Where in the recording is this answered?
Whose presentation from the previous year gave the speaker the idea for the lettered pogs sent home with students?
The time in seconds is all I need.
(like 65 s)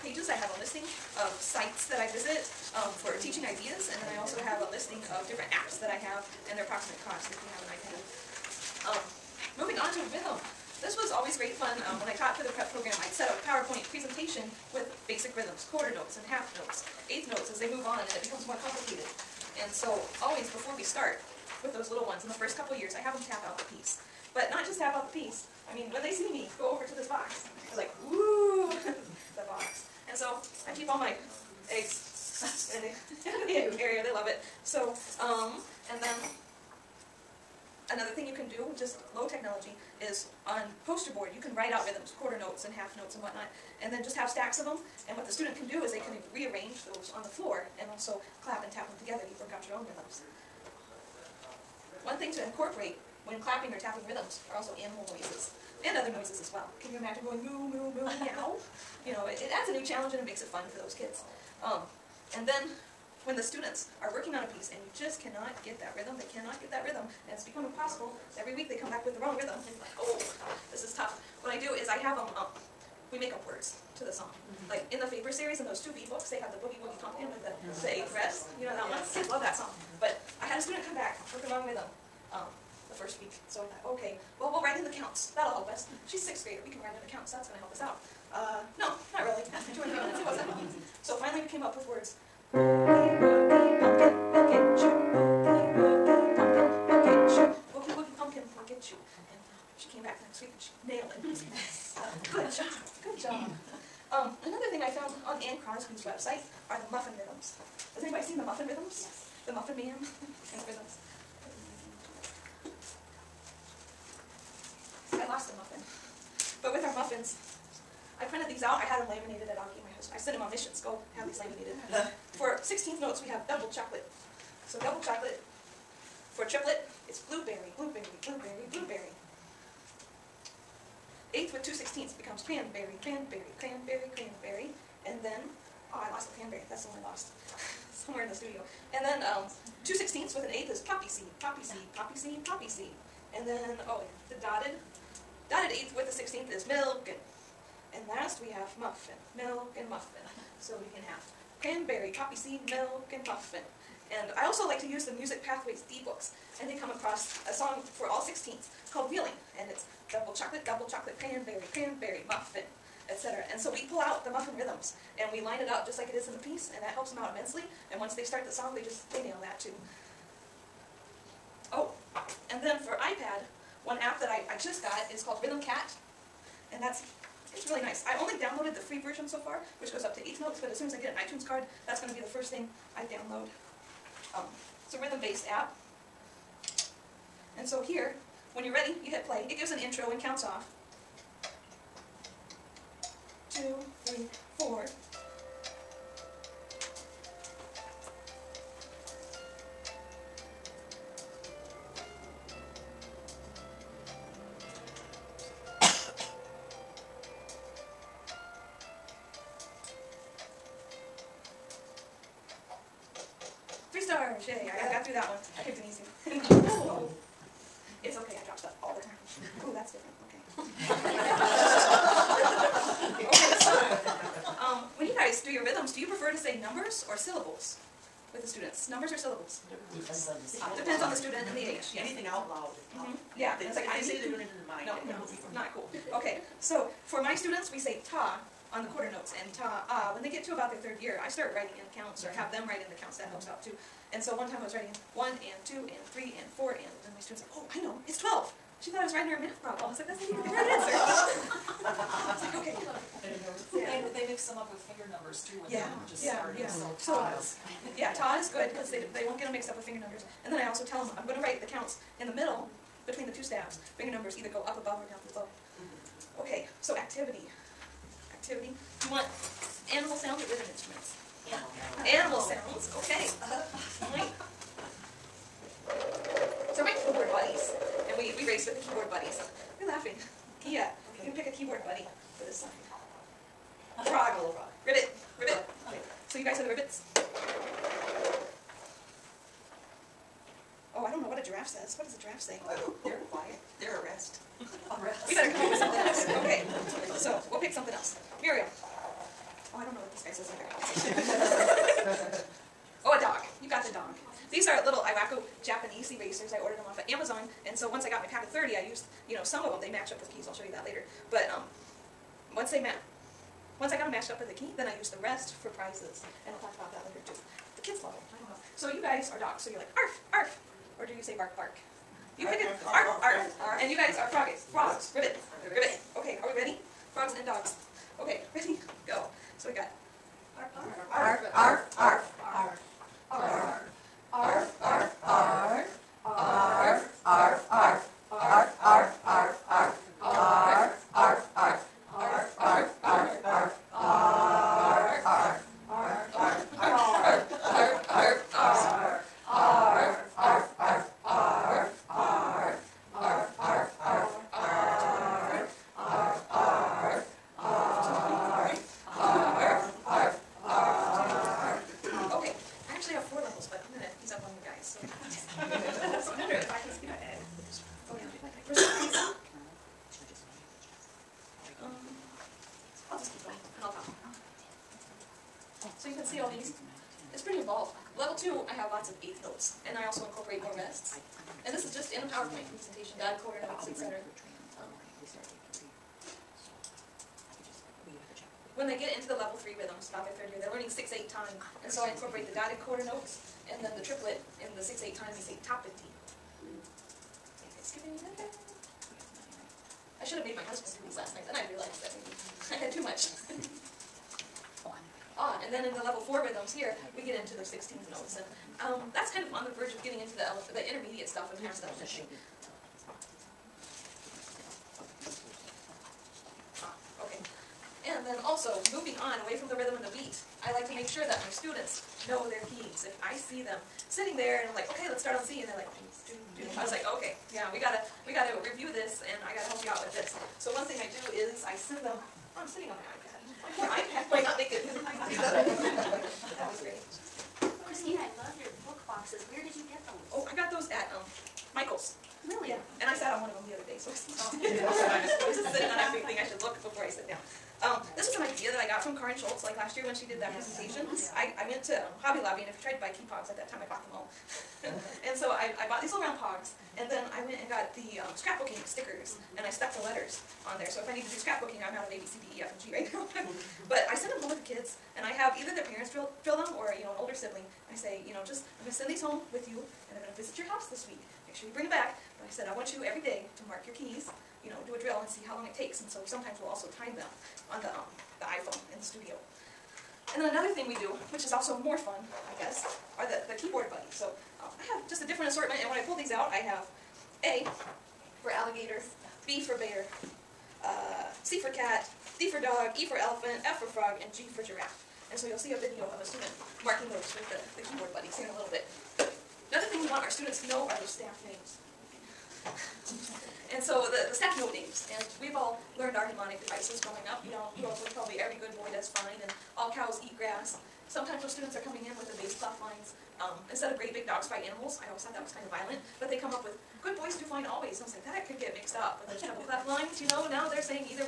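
449 s.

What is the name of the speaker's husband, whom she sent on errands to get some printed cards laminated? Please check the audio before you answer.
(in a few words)
Aki.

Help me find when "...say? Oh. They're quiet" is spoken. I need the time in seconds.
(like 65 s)
292 s.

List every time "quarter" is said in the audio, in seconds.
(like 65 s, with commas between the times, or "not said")
15 s, 42 s, 238 s, 383 s, 392 s.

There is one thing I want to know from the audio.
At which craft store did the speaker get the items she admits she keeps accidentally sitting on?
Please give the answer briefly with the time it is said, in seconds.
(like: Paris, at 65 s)
Michael's, at 441 s.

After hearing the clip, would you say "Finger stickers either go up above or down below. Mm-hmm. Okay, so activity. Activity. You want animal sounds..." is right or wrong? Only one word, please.
wrong.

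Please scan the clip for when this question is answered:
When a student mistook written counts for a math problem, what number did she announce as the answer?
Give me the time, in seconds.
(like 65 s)
248 s.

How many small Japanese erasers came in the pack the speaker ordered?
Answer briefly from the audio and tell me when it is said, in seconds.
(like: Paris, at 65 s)
30, at 308 s.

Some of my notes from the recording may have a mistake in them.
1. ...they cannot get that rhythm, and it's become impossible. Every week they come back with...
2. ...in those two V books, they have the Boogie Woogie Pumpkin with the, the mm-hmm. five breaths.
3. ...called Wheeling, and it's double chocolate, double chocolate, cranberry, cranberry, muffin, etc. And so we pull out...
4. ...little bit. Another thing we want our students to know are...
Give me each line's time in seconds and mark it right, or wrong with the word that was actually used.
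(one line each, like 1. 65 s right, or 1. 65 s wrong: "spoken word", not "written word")
1. 66 s right
2. 75 s wrong: "eight", not "five"
3. 158 s right
4. 498 s right.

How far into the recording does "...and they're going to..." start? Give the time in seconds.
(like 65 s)
470 s.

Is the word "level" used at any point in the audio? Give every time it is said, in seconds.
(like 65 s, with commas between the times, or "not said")
378 s, 389 s, 406 s.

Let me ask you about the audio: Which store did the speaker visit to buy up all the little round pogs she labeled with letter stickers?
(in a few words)
Hobby Lobby.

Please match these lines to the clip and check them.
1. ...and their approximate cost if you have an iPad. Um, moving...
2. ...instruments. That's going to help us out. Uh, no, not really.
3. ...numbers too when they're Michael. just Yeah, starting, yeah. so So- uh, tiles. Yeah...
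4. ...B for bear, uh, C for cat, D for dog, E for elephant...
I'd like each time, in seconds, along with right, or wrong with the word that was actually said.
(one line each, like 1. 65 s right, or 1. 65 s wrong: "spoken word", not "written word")
1. 6 s right
2. 87 s wrong: "counts", not "instruments"
3. 255 s wrong: "Yeah", not "Michael"
4. 489 s right.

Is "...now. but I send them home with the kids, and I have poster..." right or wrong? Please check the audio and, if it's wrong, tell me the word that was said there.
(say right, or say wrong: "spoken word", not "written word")
wrong: "either", not "poster".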